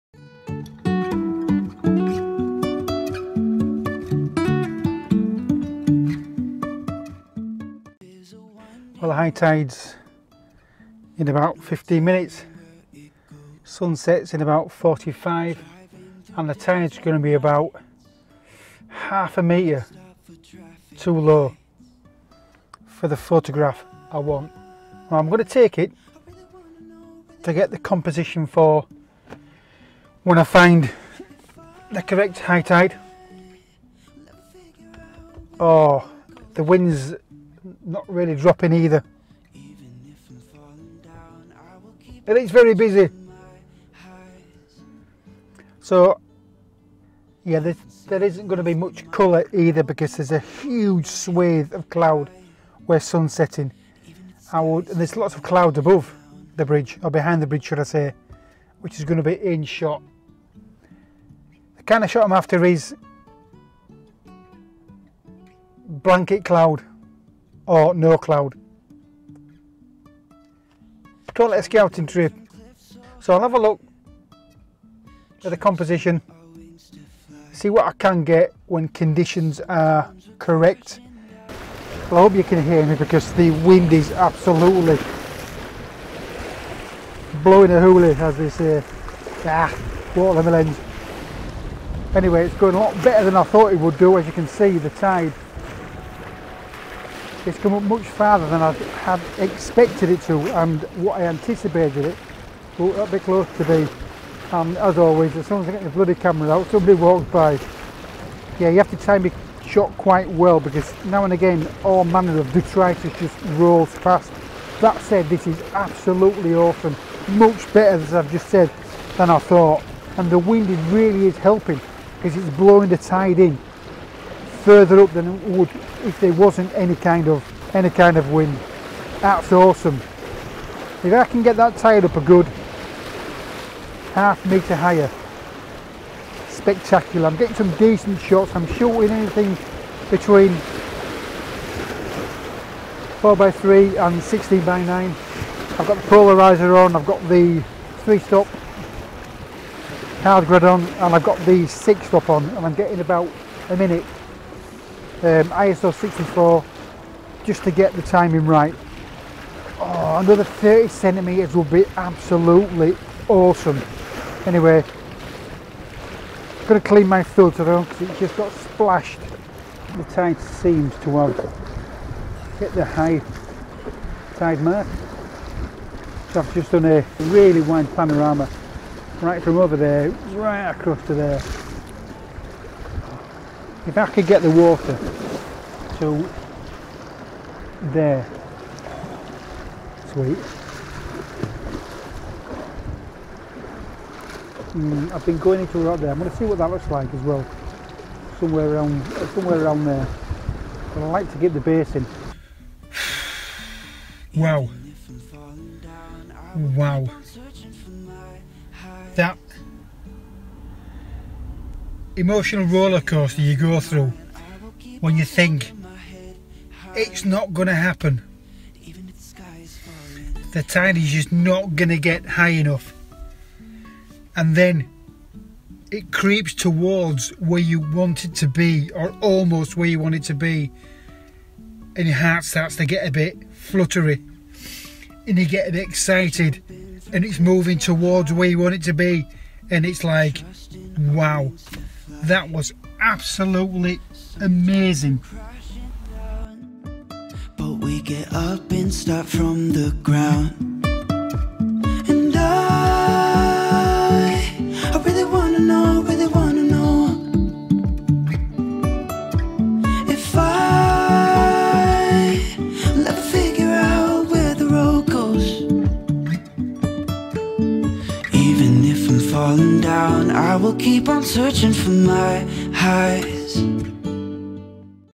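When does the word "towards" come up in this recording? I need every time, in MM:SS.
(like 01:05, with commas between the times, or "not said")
03:46, 03:57.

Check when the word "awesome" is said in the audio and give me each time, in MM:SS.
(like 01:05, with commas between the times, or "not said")
01:56, 02:09, 02:43.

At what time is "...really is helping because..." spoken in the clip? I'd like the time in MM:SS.
02:00.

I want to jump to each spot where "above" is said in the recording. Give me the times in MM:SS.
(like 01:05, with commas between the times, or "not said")
00:55.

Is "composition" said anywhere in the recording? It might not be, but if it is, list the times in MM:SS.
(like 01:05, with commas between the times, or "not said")
00:27, 01:15.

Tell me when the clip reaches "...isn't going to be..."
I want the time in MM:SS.
00:48.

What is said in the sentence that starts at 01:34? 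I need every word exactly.
As you can see, the tide it's come up much farther than I had expected it to and what I anticipated it.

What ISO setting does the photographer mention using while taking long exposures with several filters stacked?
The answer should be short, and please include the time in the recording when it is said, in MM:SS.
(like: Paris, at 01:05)
64, at 02:35.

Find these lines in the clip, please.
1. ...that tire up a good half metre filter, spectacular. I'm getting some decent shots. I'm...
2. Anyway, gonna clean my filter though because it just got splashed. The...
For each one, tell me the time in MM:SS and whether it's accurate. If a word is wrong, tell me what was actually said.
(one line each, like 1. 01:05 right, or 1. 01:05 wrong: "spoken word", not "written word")
1. 02:11 wrong: "higher", not "filter"
2. 02:44 right.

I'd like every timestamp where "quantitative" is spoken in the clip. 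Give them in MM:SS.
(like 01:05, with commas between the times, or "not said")
not said.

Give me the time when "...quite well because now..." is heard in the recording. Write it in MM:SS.
01:49.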